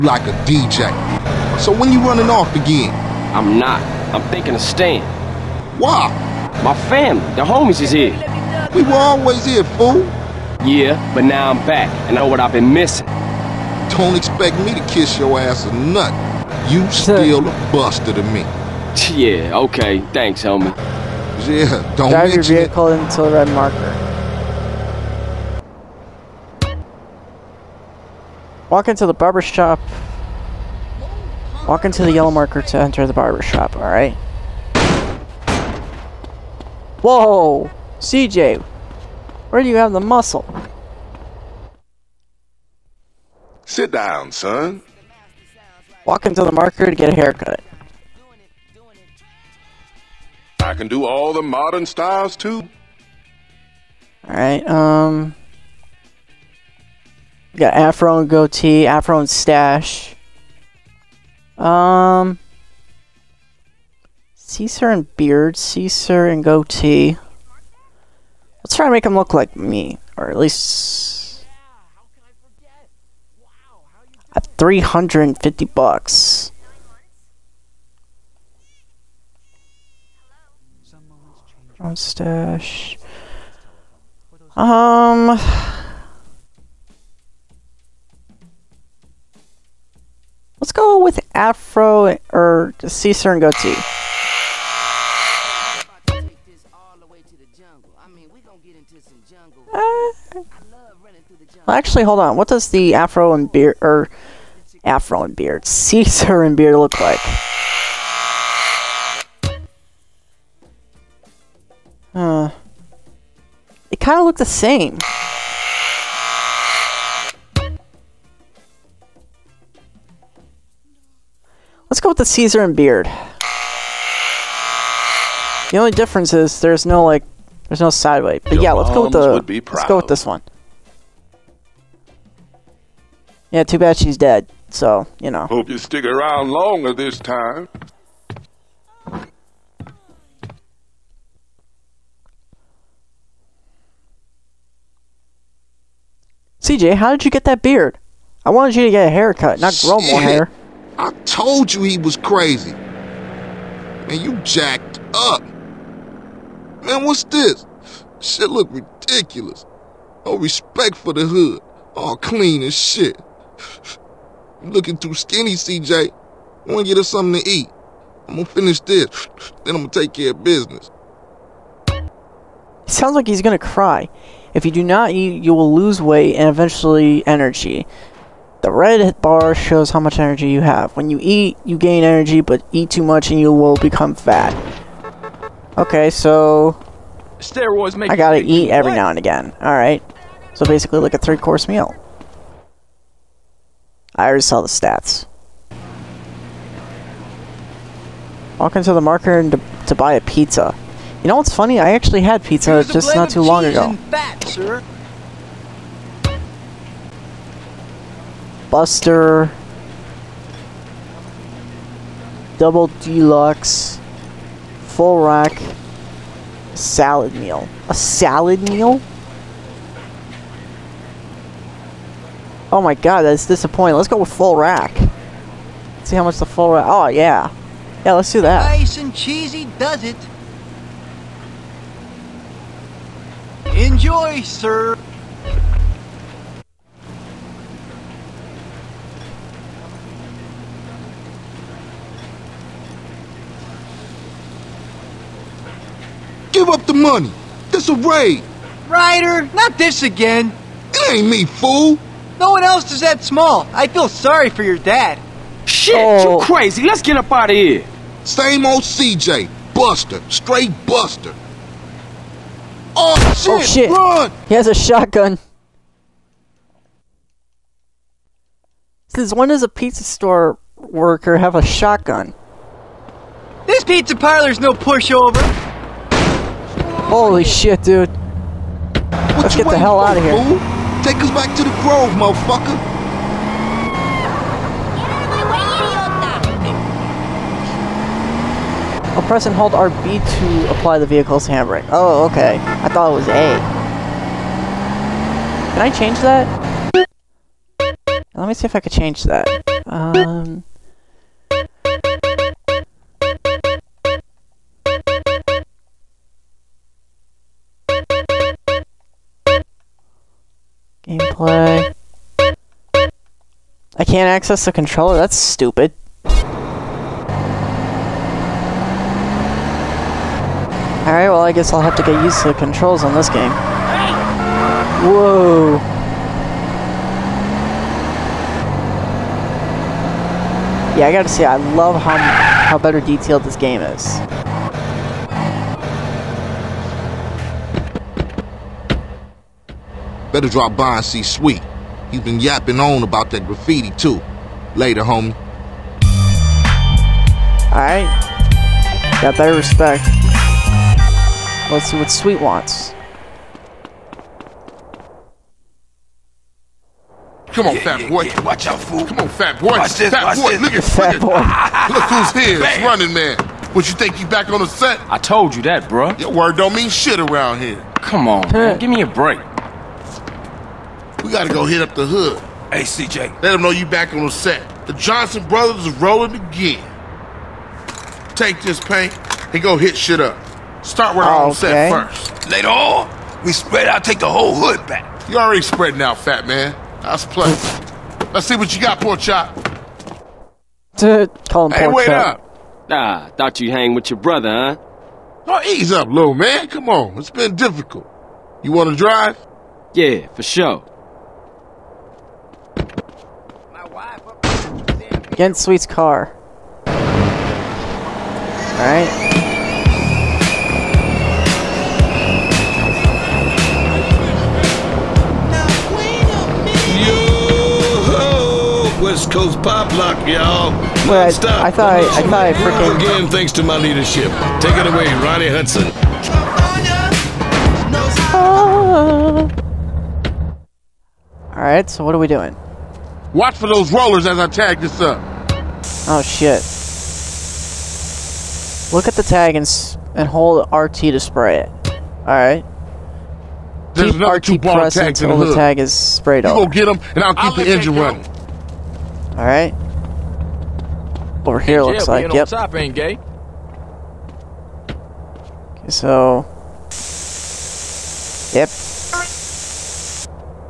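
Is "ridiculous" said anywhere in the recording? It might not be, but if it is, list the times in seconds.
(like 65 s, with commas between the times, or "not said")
158 s.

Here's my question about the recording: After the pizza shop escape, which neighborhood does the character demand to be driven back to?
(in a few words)
The Grove.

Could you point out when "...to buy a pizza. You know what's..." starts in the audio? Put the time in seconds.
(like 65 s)
199 s.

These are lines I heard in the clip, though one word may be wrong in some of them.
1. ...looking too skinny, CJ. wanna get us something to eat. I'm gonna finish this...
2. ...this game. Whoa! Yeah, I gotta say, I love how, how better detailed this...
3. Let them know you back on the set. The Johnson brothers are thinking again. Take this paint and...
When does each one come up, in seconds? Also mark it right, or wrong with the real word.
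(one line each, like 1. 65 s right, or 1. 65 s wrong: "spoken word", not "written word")
1. 164 s right
2. 323 s right
3. 373 s wrong: "rolling", not "thinking".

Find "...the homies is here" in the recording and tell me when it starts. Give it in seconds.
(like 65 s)
7 s.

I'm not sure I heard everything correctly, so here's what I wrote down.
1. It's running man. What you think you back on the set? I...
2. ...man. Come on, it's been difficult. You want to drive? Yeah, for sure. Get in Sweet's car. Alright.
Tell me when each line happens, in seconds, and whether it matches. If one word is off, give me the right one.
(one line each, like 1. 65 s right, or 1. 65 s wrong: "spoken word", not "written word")
1. 362 s right
2. 396 s right.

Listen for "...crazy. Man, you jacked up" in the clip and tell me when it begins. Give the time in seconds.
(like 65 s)
152 s.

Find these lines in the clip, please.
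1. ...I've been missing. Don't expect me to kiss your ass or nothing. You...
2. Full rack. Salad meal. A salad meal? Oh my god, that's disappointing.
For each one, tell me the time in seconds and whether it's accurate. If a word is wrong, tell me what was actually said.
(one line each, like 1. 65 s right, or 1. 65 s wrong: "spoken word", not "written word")
1. 12 s right
2. 214 s right.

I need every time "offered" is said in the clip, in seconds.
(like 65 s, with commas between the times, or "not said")
not said.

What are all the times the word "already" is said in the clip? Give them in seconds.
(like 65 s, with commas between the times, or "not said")
194 s, 385 s.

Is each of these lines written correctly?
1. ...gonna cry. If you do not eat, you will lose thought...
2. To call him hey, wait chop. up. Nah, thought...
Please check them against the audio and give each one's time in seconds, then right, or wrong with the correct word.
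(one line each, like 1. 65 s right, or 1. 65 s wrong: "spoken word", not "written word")
1. 173 s wrong: "weight", not "thought"
2. 390 s right.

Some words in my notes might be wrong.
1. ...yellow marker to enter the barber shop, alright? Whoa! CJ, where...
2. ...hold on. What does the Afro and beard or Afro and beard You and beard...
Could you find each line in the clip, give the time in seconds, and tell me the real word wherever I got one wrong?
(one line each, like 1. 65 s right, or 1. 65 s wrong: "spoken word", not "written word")
1. 32 s right
2. 102 s wrong: "Caesar", not "You".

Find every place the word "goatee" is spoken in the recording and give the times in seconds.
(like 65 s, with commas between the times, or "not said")
58 s, 66 s, 93 s.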